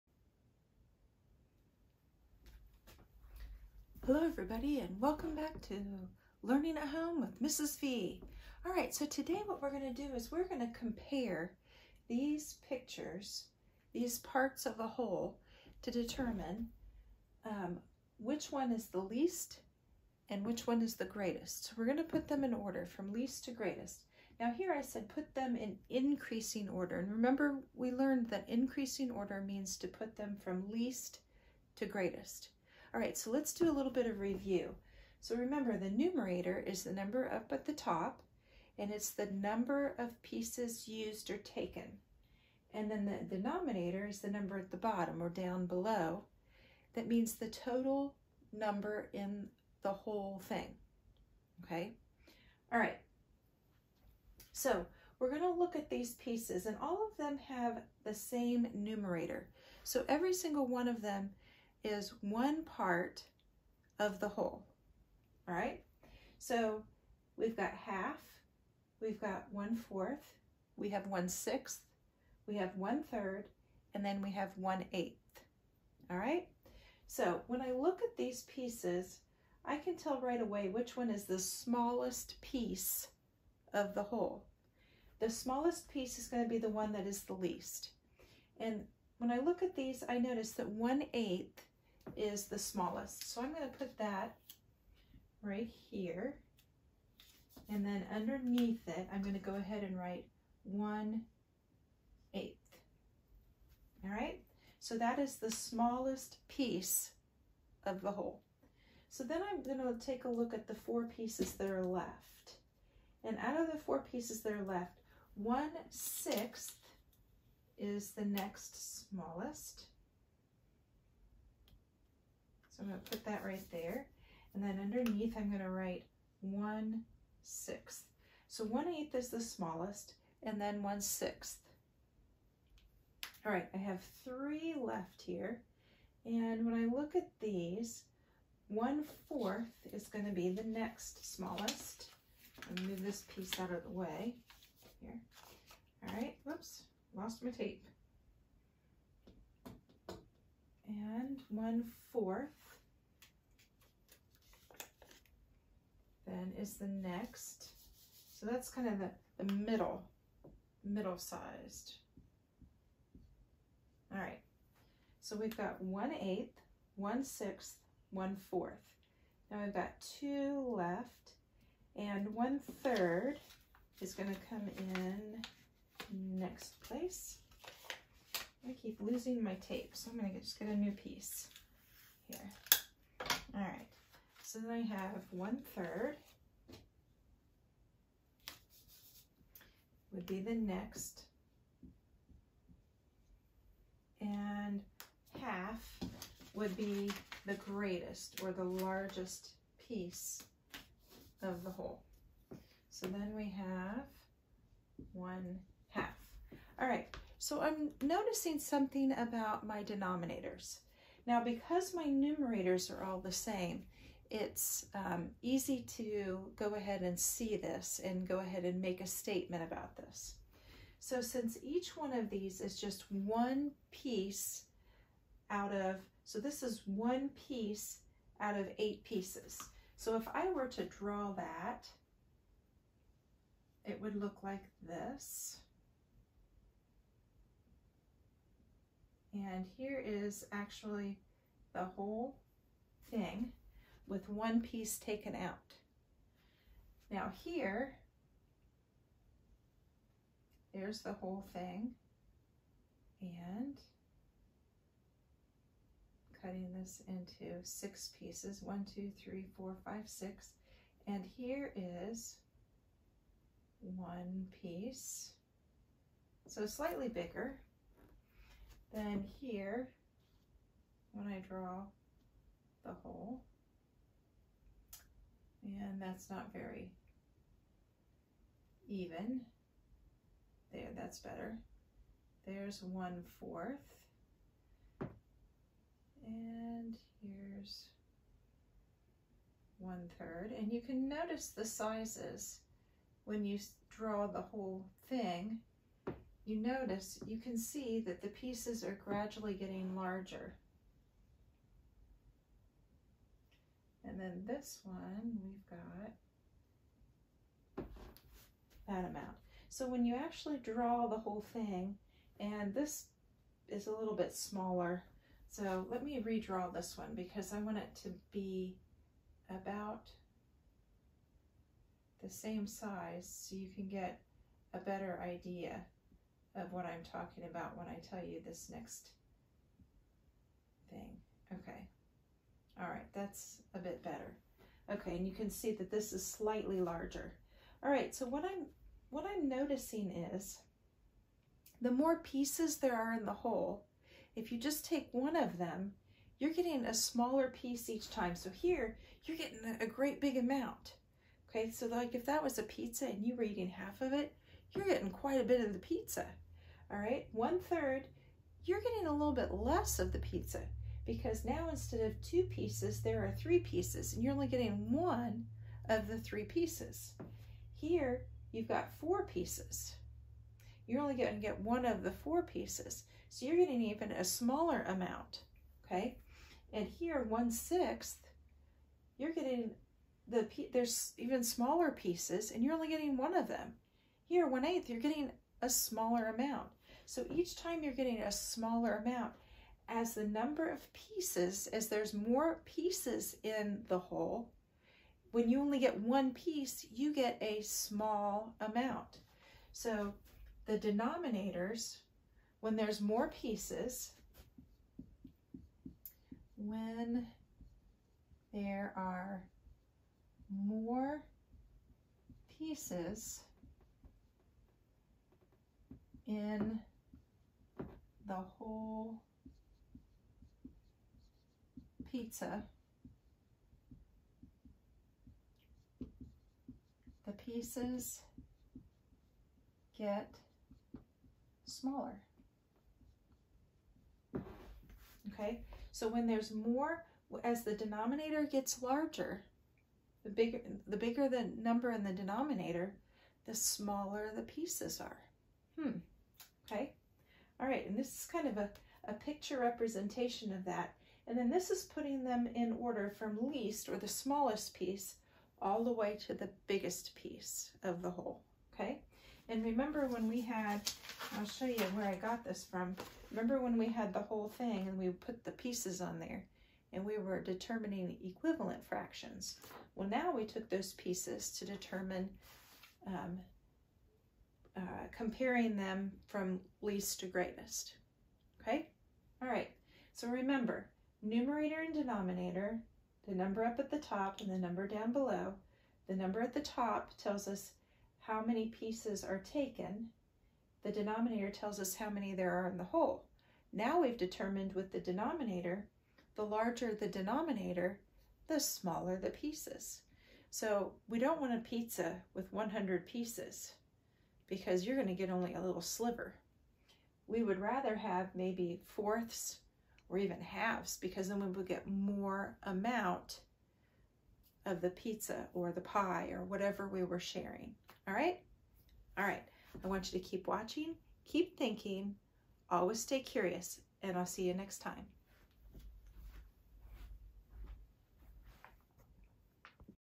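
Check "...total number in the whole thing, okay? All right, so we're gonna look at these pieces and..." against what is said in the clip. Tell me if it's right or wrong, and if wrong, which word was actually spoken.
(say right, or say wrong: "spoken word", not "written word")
right.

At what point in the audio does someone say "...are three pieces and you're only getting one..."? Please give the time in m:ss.
6:03.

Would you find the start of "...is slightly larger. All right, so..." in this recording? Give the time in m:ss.
5:36.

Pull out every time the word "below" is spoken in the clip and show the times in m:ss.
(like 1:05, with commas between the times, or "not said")
0:45, 8:05.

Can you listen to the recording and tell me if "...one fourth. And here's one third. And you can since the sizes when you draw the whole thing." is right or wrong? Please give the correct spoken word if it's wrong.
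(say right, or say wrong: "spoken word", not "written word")
wrong: "notice", not "since".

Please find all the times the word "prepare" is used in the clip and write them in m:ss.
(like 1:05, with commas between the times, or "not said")
not said.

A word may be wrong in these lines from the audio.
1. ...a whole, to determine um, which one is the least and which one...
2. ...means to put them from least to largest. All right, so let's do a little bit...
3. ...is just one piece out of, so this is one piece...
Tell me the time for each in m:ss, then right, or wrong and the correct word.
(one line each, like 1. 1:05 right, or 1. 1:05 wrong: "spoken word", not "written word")
1. 0:14 right
2. 0:29 wrong: "greatest", not "largest"
3. 3:42 right.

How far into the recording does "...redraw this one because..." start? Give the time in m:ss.
5:16.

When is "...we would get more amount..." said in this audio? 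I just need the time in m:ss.
8:31.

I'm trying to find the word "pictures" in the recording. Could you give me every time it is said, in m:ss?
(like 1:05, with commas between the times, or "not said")
0:12, 7:29.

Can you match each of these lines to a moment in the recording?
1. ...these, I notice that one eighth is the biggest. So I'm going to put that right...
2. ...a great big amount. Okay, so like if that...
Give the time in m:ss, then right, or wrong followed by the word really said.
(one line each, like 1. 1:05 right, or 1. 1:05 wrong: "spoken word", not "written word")
1. 1:29 wrong: "smallest", not "biggest"
2. 5:49 right.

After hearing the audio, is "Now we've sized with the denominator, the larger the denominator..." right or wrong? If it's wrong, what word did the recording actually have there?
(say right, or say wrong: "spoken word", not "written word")
wrong: "determined", not "sized".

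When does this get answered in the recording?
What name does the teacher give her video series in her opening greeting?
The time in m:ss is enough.
0:06.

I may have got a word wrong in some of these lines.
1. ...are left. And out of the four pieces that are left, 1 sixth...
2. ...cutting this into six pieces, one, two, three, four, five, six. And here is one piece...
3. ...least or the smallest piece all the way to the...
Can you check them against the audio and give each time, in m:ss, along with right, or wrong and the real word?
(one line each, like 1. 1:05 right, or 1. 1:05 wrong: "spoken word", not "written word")
1. 1:51 right
2. 4:16 right
3. 7:33 right.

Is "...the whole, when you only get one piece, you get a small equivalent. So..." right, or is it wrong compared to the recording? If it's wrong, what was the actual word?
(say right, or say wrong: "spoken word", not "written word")
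wrong: "amount", not "equivalent".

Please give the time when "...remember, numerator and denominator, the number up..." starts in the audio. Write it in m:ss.
8:00.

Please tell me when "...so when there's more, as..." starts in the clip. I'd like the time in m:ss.
7:15.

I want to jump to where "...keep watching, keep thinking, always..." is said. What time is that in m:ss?
8:40.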